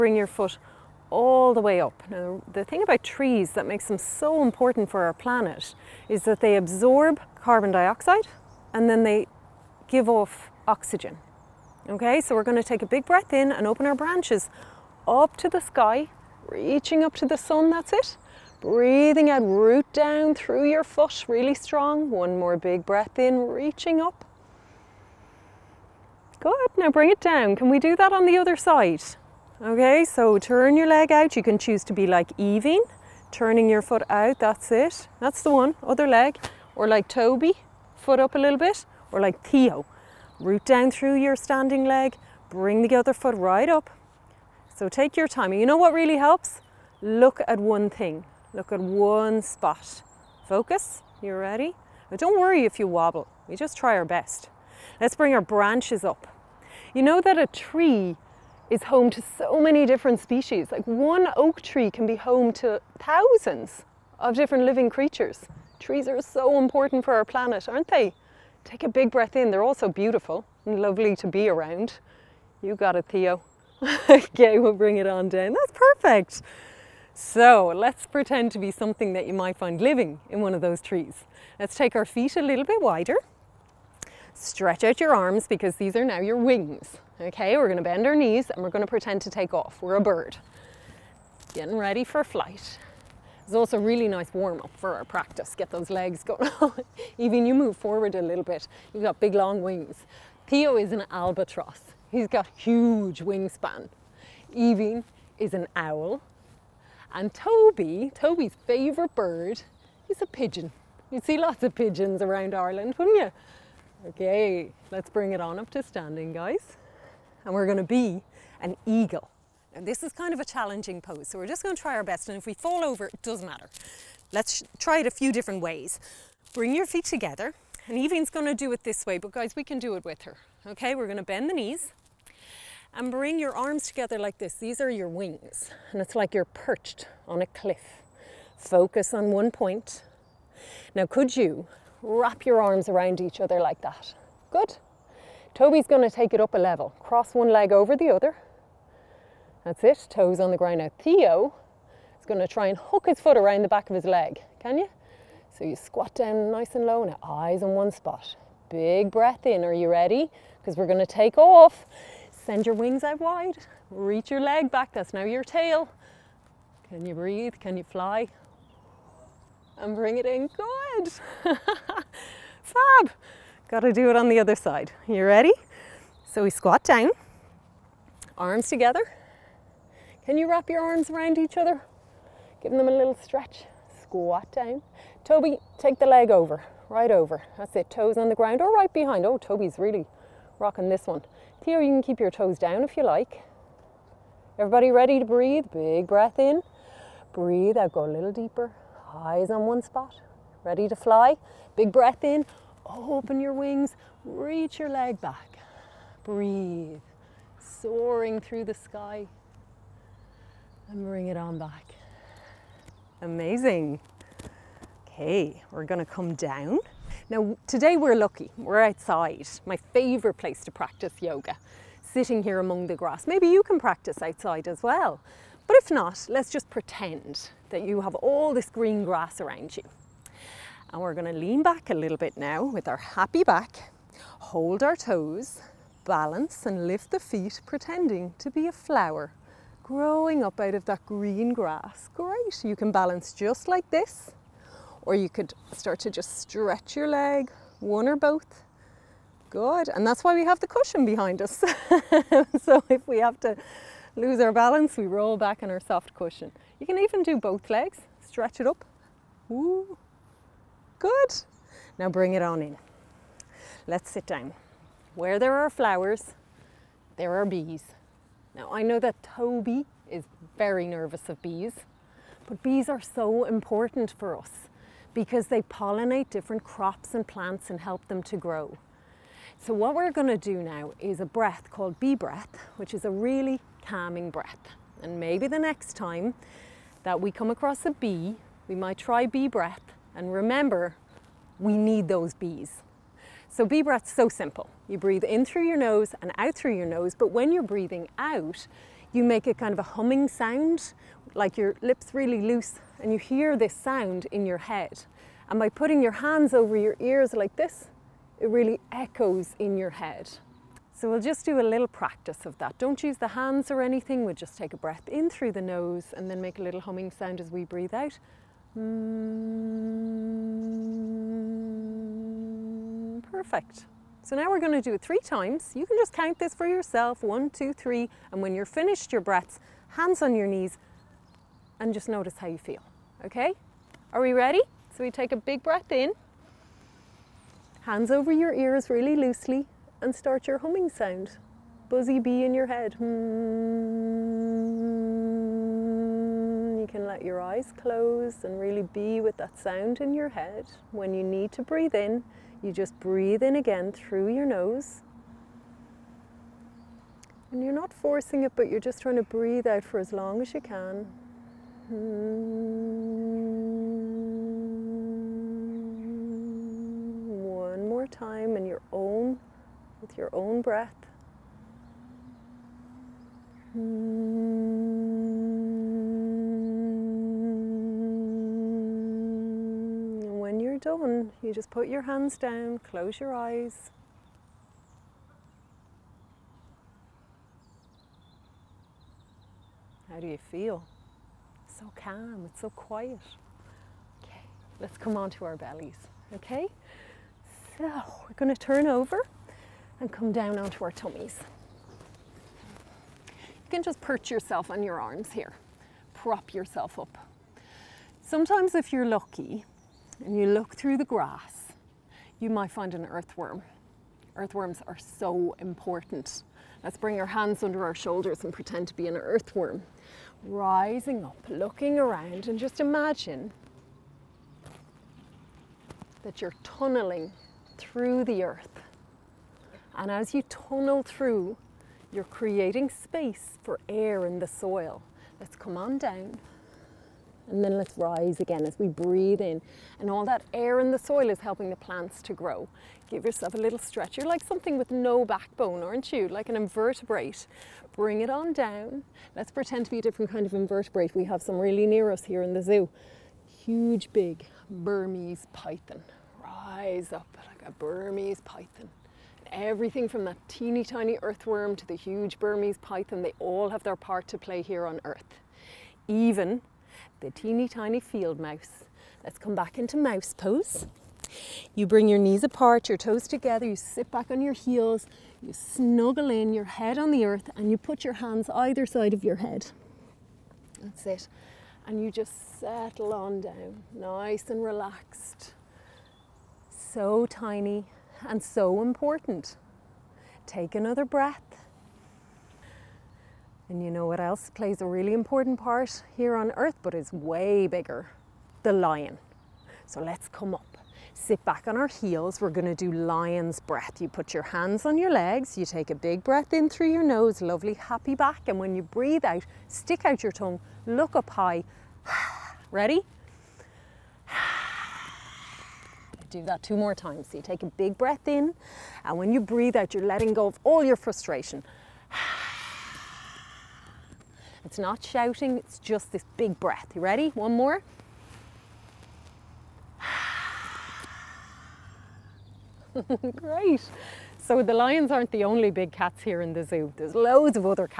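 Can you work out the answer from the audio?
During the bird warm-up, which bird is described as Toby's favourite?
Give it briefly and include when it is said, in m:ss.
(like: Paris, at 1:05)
Pigeon, at 1:50.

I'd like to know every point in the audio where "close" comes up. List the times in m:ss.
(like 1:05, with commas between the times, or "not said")
5:47, 6:22.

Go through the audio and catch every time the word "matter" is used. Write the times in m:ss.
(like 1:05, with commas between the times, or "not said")
2:03.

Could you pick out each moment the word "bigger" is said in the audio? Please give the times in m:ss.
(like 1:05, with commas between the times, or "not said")
8:17.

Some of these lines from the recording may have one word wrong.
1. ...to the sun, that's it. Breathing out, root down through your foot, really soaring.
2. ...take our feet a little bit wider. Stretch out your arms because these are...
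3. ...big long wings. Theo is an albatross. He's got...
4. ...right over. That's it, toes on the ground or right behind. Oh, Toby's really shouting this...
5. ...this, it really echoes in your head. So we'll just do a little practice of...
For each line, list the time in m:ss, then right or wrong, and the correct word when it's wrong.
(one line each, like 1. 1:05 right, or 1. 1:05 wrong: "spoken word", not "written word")
1. 0:17 wrong: "strong", not "soaring"
2. 1:21 right
3. 1:39 right
4. 3:06 wrong: "rocking", not "shouting"
5. 5:07 right.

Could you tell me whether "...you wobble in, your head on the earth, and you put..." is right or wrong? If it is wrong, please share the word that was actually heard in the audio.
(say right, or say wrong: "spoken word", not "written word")
wrong: "snuggle", not "wobble".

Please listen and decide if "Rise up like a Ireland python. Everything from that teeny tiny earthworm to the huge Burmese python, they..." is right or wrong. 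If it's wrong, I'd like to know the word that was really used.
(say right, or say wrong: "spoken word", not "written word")
wrong: "Burmese", not "Ireland".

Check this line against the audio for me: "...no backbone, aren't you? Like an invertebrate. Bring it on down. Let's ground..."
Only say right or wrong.
wrong.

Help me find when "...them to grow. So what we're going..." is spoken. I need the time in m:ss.
4:38.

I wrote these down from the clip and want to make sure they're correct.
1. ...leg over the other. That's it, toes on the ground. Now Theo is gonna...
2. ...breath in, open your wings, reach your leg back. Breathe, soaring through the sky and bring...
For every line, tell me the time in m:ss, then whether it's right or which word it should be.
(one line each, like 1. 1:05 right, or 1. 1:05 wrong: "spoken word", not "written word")
1. 2:27 right
2. 3:21 right.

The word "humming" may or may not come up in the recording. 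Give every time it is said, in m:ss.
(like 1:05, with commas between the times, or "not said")
4:59, 5:16, 5:40.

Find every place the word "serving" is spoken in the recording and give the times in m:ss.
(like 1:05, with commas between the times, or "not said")
not said.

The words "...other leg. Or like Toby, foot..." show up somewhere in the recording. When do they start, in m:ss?
0:35.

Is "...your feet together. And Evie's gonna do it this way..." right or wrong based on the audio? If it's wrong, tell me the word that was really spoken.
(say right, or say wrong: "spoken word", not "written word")
right.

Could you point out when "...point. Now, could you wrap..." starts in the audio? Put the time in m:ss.
2:19.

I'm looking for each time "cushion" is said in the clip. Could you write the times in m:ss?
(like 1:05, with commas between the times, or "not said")
4:10, 4:16.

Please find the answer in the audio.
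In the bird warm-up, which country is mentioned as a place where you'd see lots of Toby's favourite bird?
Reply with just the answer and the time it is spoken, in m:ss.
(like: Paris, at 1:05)
Ireland, at 1:52.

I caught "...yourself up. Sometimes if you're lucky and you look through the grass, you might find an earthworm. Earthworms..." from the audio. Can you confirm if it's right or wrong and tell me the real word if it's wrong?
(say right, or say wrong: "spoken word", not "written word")
right.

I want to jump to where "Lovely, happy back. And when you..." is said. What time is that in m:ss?
8:27.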